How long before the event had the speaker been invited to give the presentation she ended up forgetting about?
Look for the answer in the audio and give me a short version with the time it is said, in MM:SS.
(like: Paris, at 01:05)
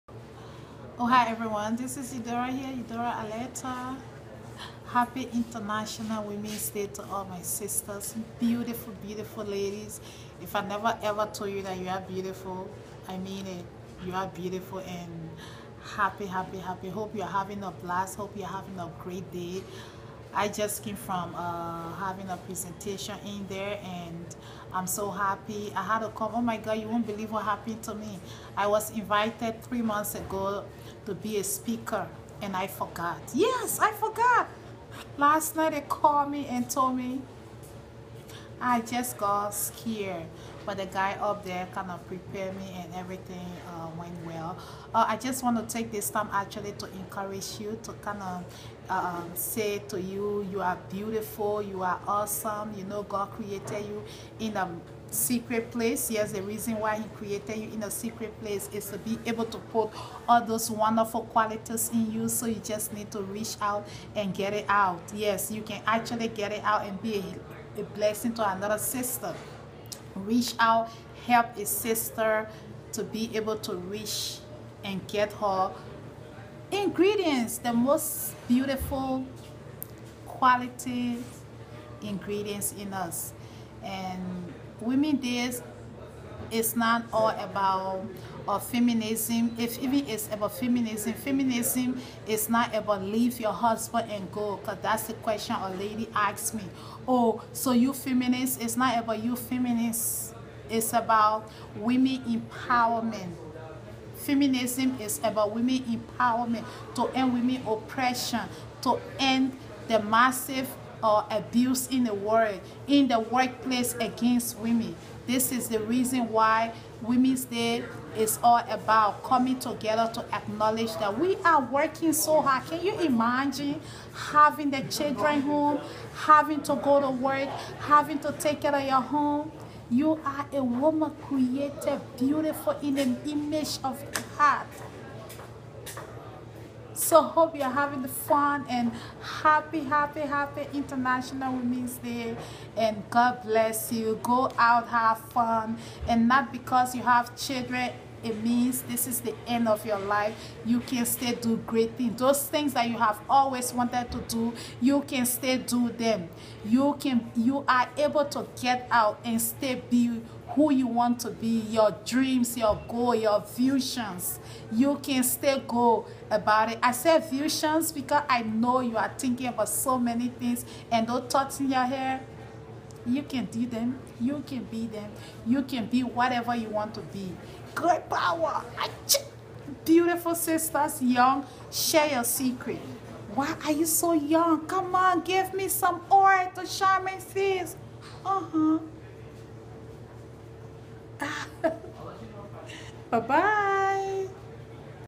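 3 months, at 00:29.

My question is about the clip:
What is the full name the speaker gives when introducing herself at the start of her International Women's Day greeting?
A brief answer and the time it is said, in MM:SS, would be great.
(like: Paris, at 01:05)
Eudora Aletta, at 00:02.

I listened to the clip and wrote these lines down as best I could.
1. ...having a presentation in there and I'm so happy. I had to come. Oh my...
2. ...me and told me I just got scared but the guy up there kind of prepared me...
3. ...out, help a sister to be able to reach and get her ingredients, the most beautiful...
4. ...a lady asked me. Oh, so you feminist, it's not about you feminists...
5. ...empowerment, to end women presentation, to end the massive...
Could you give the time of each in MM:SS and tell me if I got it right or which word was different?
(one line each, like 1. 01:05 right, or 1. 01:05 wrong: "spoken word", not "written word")
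1. 00:21 right
2. 00:36 right
3. 01:10 right
4. 01:35 right
5. 01:45 wrong: "oppression", not "presentation".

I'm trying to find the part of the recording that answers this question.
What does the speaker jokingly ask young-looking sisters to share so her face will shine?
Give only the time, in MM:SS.
03:06.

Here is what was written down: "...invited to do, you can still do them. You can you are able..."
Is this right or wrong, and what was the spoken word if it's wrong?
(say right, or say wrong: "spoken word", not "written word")
wrong: "wanted", not "invited".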